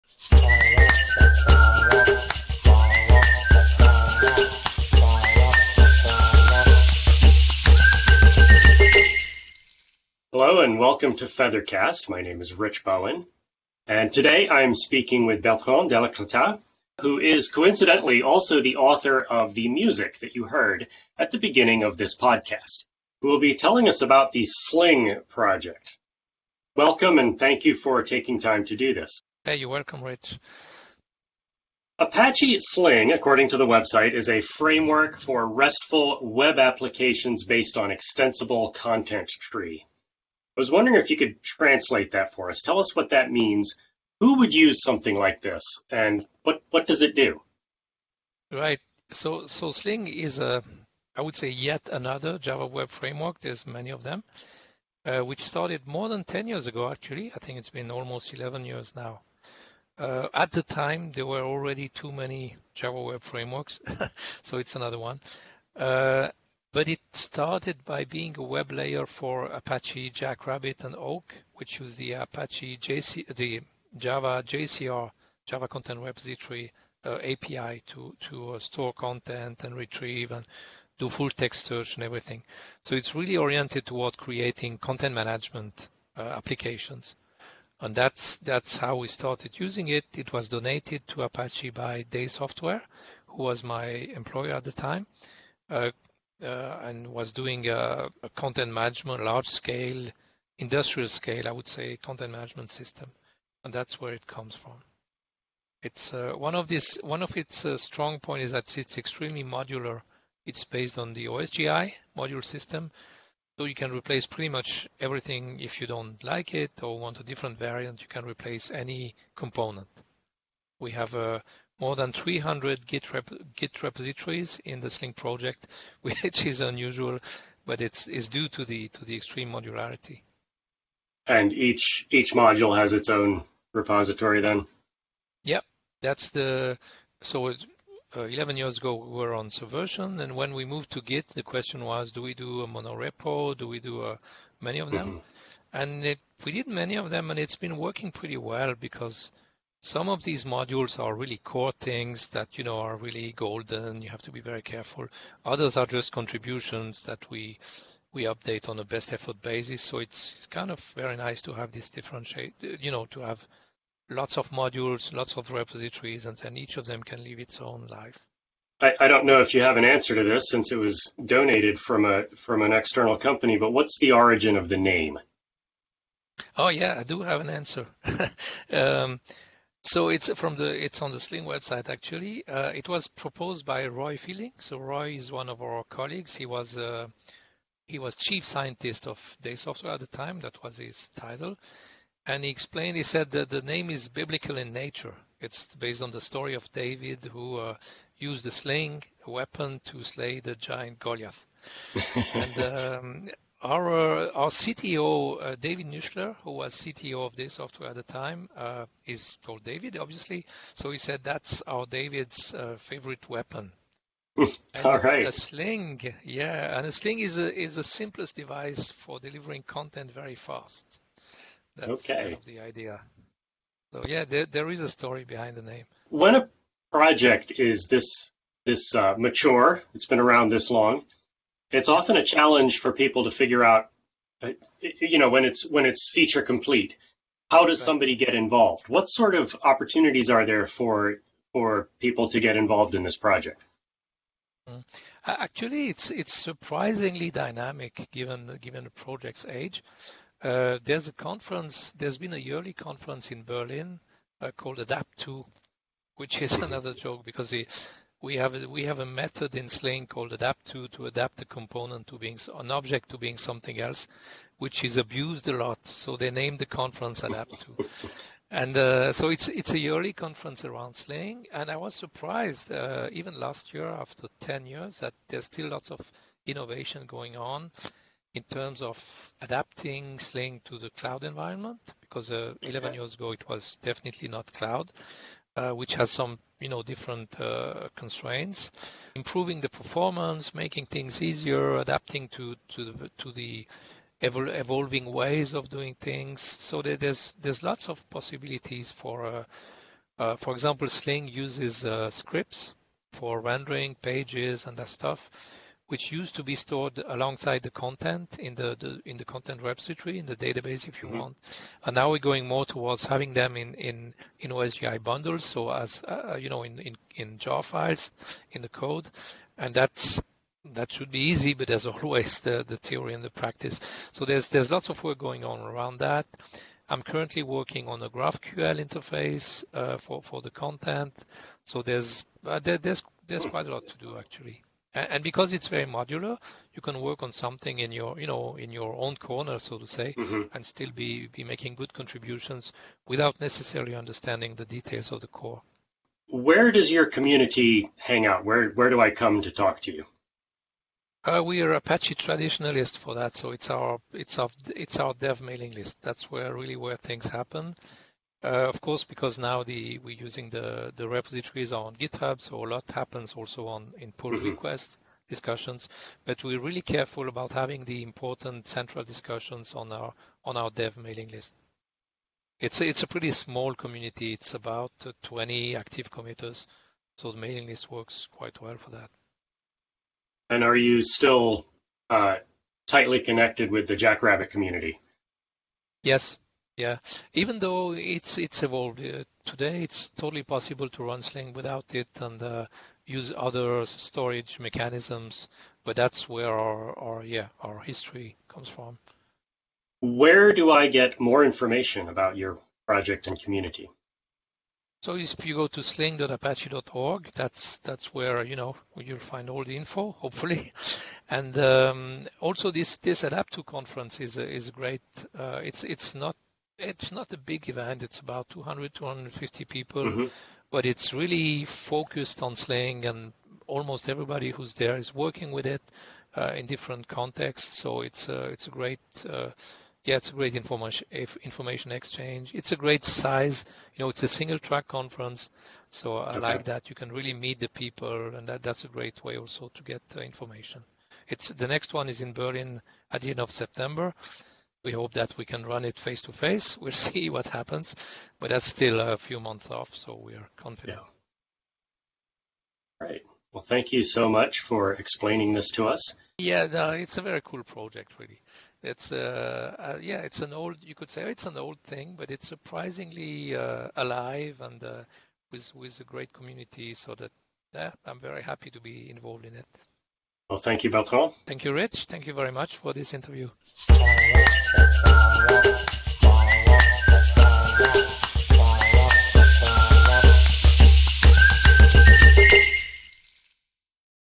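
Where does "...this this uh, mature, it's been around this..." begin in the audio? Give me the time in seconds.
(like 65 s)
227 s.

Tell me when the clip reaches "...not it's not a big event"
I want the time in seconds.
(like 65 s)
416 s.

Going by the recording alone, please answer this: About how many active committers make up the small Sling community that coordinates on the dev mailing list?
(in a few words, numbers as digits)
20.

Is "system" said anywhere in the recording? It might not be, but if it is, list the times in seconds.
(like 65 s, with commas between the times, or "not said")
102 s, 112 s.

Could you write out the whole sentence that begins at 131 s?
And each, each module has its own repository then?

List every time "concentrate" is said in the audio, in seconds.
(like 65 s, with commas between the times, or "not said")
not said.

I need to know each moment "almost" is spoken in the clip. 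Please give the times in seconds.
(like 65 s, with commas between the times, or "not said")
57 s, 423 s.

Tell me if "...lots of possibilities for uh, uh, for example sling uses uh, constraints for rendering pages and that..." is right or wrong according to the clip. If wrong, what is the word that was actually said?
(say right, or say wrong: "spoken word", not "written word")
wrong: "scripts", not "constraints".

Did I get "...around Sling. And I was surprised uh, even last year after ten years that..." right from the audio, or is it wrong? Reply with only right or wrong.
right.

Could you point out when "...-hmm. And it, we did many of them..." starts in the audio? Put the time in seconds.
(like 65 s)
145 s.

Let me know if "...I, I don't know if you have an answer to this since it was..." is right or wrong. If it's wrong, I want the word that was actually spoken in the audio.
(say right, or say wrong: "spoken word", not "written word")
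right.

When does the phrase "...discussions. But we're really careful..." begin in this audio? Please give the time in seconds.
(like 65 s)
365 s.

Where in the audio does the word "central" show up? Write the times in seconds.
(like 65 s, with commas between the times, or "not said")
368 s.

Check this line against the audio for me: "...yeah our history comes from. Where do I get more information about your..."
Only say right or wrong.
right.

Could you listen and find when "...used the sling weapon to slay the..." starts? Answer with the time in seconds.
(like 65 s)
198 s.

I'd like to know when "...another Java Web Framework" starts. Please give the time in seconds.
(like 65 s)
51 s.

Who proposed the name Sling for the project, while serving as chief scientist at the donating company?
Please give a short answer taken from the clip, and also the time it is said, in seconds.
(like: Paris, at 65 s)
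Roy Fielding, at 183 s.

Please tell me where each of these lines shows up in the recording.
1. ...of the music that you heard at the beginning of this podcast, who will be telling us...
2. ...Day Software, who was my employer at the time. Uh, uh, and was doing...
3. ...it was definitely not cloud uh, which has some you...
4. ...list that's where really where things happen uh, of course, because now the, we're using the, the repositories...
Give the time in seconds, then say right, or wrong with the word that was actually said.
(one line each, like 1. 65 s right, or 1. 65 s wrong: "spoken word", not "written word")
1. 19 s right
2. 92 s right
3. 283 s right
4. 355 s right.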